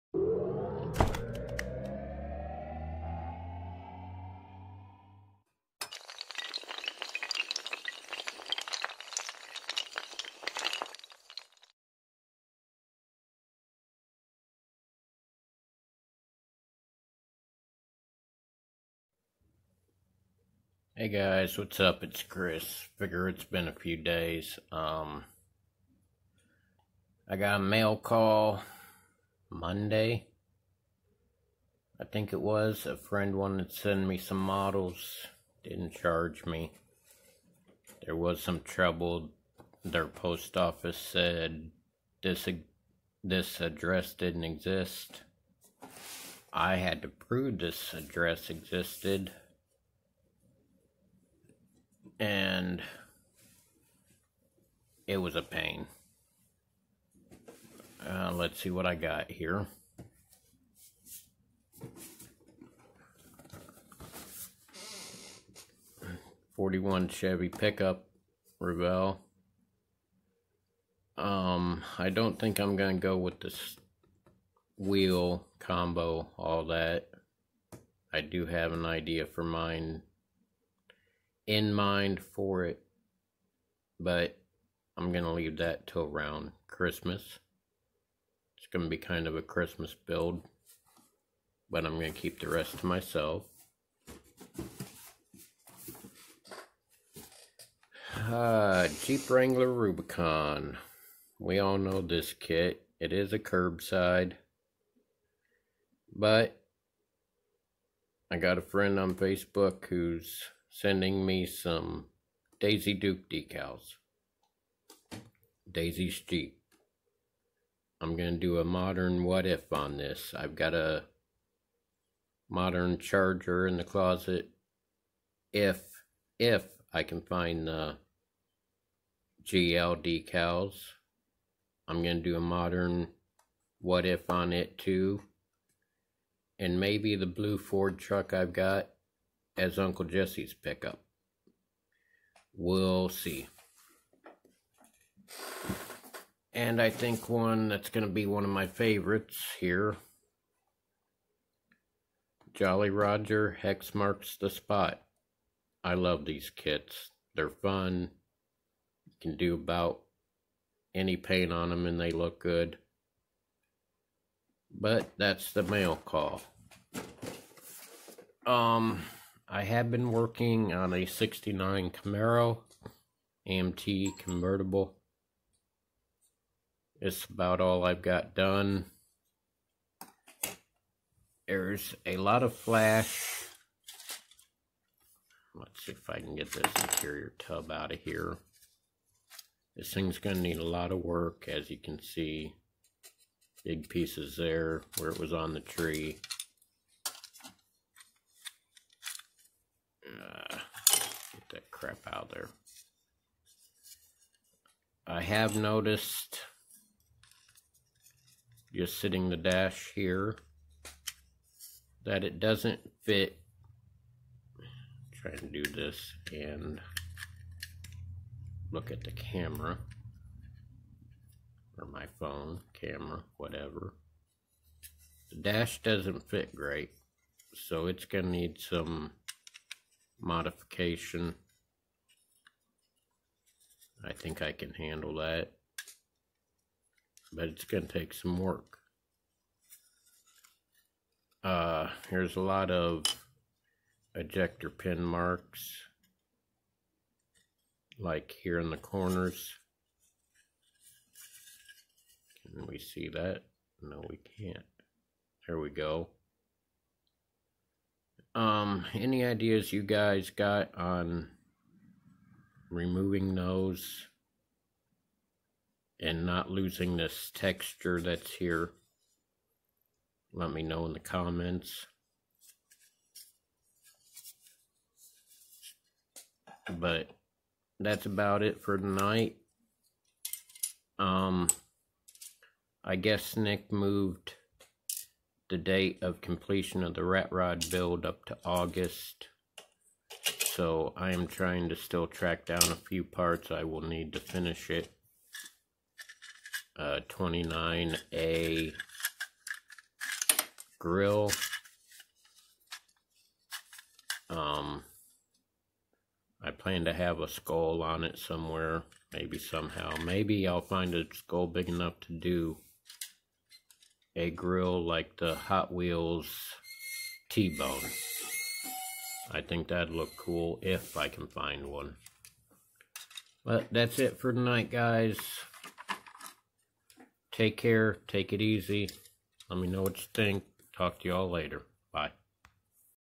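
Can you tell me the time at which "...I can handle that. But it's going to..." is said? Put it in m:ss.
3:54.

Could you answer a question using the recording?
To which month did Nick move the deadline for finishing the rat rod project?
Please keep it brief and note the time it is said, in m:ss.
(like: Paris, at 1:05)
August, at 4:48.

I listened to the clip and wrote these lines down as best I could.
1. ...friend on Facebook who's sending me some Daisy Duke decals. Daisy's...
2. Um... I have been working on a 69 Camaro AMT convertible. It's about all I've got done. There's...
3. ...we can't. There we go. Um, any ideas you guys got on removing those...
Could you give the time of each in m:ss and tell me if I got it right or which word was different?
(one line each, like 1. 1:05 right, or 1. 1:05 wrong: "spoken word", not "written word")
1. 1:48 right
2. 2:48 right
3. 4:14 right.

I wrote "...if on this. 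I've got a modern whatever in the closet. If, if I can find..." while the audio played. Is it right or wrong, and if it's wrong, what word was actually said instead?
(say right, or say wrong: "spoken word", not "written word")
wrong: "charger", not "whatever".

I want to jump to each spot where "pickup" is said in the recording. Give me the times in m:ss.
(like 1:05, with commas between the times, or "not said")
1:07, 2:20.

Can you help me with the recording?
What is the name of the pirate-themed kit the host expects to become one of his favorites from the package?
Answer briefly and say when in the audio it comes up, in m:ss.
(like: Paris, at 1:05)
Jolly Roger, at 2:32.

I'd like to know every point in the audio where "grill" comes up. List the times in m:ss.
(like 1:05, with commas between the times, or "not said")
5:00, 5:14.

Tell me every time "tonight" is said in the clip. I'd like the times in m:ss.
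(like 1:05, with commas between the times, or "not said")
4:38, 5:24.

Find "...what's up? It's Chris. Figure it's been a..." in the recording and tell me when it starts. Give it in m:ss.
0:21.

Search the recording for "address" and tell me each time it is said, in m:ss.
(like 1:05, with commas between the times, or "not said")
0:43, 0:47.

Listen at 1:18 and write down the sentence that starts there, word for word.
I do have an idea for mine in mind for it, but I'm going to leave that till around Christmas.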